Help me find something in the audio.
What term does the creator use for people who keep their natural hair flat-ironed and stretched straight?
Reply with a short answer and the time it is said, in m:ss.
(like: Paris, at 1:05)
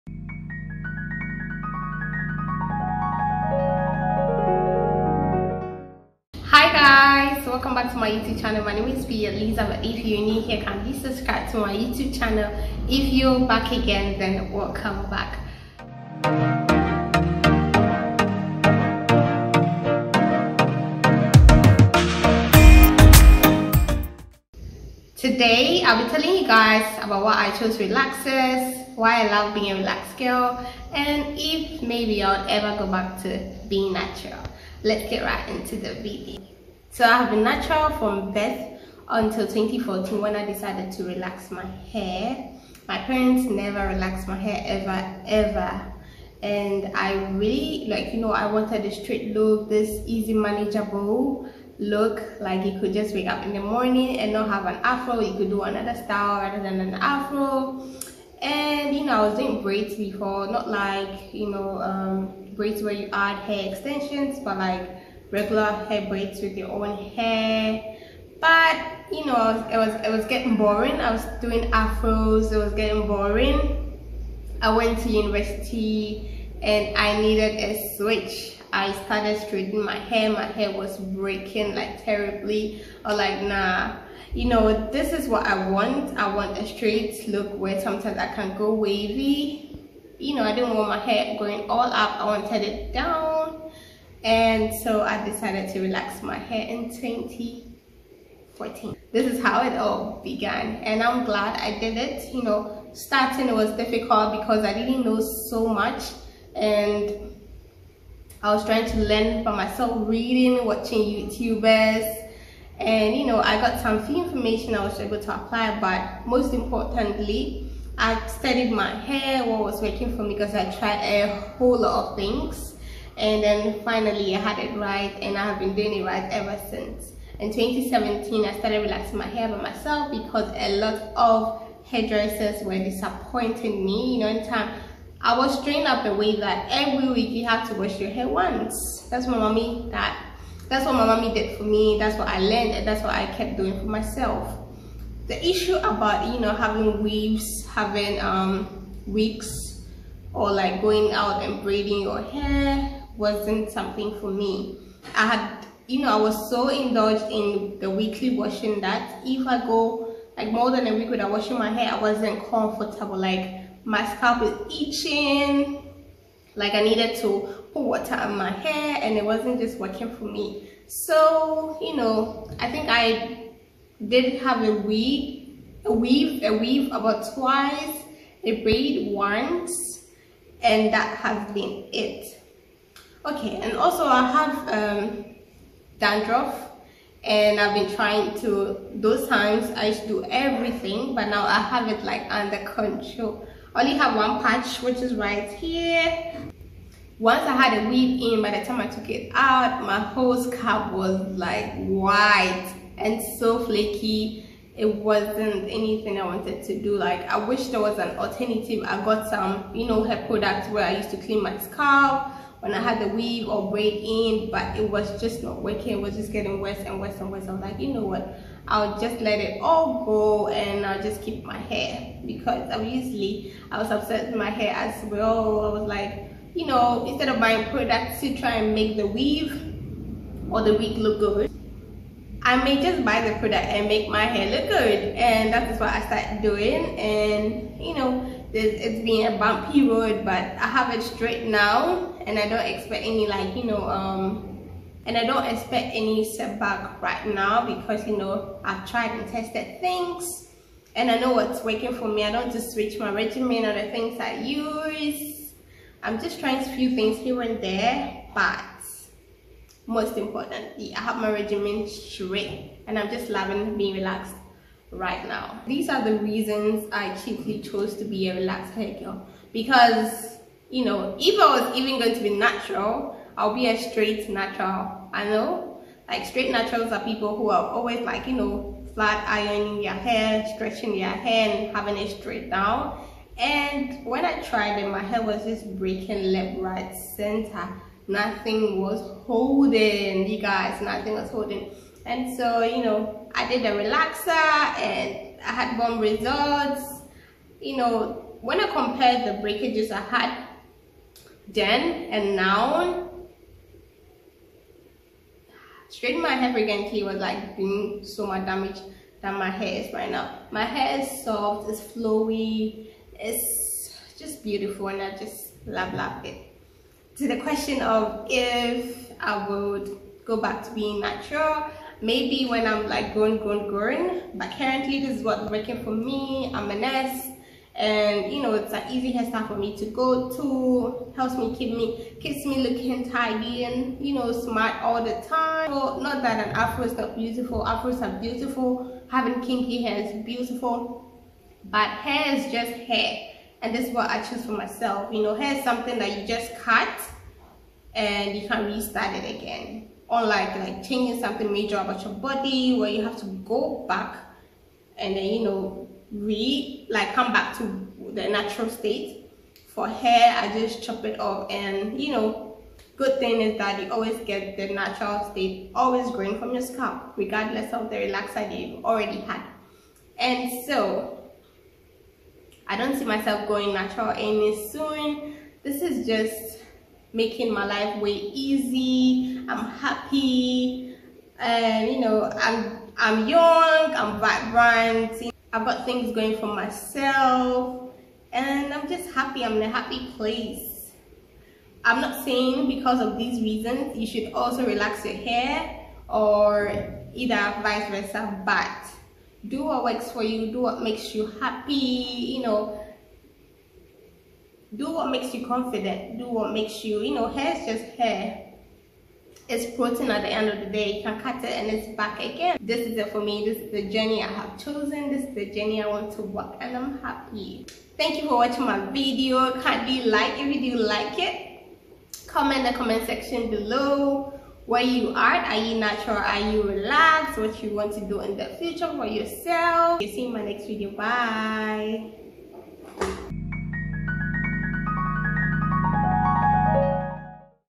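straight naturals, at 4:36.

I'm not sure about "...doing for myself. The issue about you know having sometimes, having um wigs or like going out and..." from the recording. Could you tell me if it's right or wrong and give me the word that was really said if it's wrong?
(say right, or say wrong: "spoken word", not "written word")
wrong: "weaves", not "sometimes".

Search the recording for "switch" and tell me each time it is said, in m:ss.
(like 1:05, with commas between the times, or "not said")
1:17, 4:12.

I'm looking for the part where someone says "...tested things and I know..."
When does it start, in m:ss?
4:09.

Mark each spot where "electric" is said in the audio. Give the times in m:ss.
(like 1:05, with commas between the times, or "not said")
not said.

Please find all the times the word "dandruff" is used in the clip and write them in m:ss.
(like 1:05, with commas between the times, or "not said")
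3:05.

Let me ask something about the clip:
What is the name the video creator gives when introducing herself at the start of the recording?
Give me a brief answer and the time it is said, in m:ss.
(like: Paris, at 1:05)
Pea, at 0:09.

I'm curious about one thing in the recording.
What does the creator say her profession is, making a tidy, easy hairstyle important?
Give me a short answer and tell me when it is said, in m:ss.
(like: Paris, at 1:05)
nurse, at 5:26.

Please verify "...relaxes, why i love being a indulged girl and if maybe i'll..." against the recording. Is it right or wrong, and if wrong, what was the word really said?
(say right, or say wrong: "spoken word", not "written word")
wrong: "relaxed", not "indulged".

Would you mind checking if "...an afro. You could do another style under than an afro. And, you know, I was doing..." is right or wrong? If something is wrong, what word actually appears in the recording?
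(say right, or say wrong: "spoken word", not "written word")
wrong: "rather", not "under".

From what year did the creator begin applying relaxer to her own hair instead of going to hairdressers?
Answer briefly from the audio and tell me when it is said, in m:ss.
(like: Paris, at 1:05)
2017, at 2:07.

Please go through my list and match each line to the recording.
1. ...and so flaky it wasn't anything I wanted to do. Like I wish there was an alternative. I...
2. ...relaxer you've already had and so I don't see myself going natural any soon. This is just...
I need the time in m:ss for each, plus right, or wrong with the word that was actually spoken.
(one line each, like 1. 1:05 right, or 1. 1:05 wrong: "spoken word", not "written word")
1. 3:22 right
2. 6:07 right.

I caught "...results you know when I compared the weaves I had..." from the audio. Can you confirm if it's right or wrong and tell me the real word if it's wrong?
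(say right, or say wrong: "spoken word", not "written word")
wrong: "breakages", not "weaves".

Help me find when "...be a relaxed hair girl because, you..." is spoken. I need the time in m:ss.
4:28.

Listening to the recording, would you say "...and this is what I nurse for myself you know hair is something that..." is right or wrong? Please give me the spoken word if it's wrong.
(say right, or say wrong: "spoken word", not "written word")
wrong: "choose", not "nurse".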